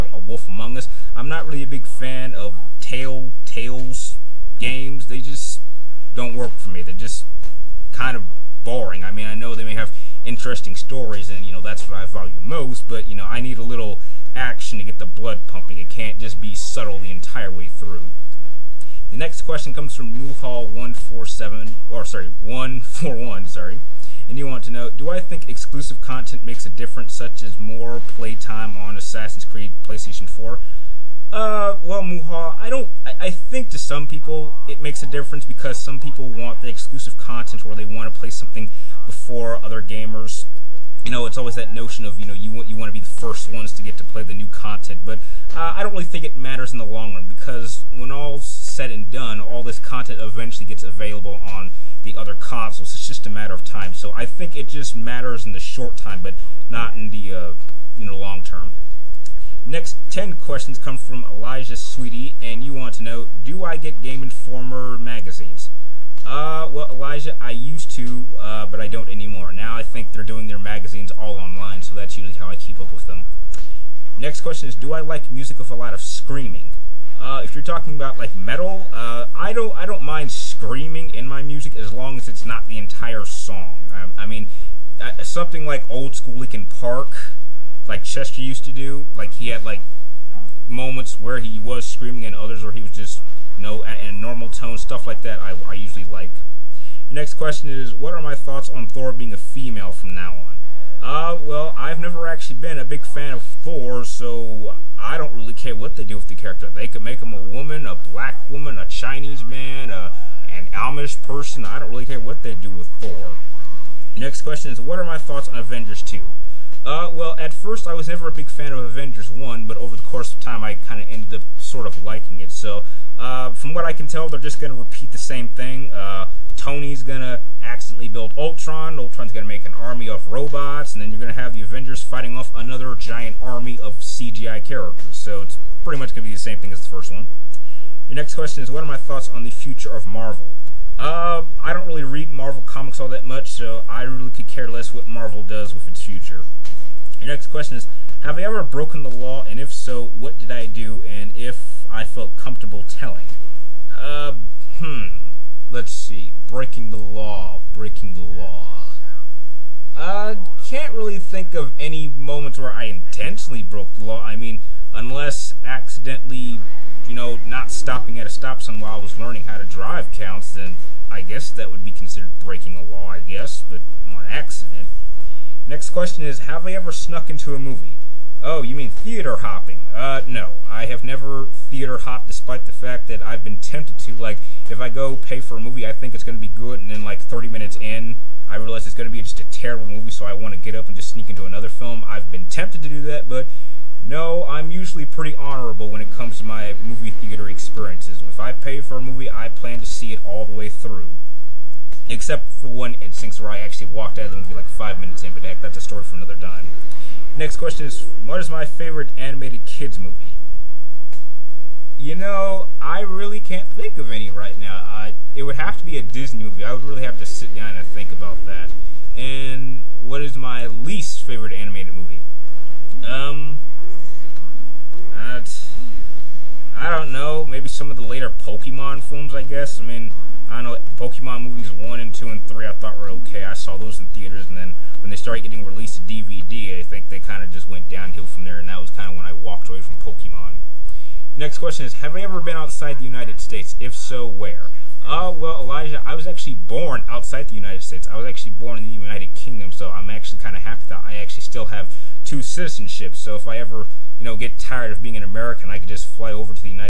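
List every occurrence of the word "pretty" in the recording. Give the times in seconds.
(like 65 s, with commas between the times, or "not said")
135 s, 195 s.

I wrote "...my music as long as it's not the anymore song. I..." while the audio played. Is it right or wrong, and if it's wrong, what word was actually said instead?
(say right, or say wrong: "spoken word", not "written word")
wrong: "entire", not "anymore".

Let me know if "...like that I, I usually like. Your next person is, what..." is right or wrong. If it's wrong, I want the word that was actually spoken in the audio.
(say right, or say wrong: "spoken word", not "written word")
wrong: "question", not "person".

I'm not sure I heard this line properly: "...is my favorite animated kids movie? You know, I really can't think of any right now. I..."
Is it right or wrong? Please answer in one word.
right.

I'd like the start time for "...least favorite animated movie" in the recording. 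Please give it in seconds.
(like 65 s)
220 s.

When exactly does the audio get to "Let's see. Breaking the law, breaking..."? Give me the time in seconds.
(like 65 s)
155 s.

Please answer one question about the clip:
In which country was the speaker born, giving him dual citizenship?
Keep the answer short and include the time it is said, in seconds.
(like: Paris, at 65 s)
United Kingdom, at 248 s.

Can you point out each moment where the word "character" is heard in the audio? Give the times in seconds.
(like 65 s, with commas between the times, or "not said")
106 s, 134 s.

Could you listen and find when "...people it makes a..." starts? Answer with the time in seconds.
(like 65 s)
34 s.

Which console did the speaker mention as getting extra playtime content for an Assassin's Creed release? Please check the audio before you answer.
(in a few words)
PlayStation 4.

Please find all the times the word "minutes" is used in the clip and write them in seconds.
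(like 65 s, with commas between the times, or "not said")
187 s, 204 s.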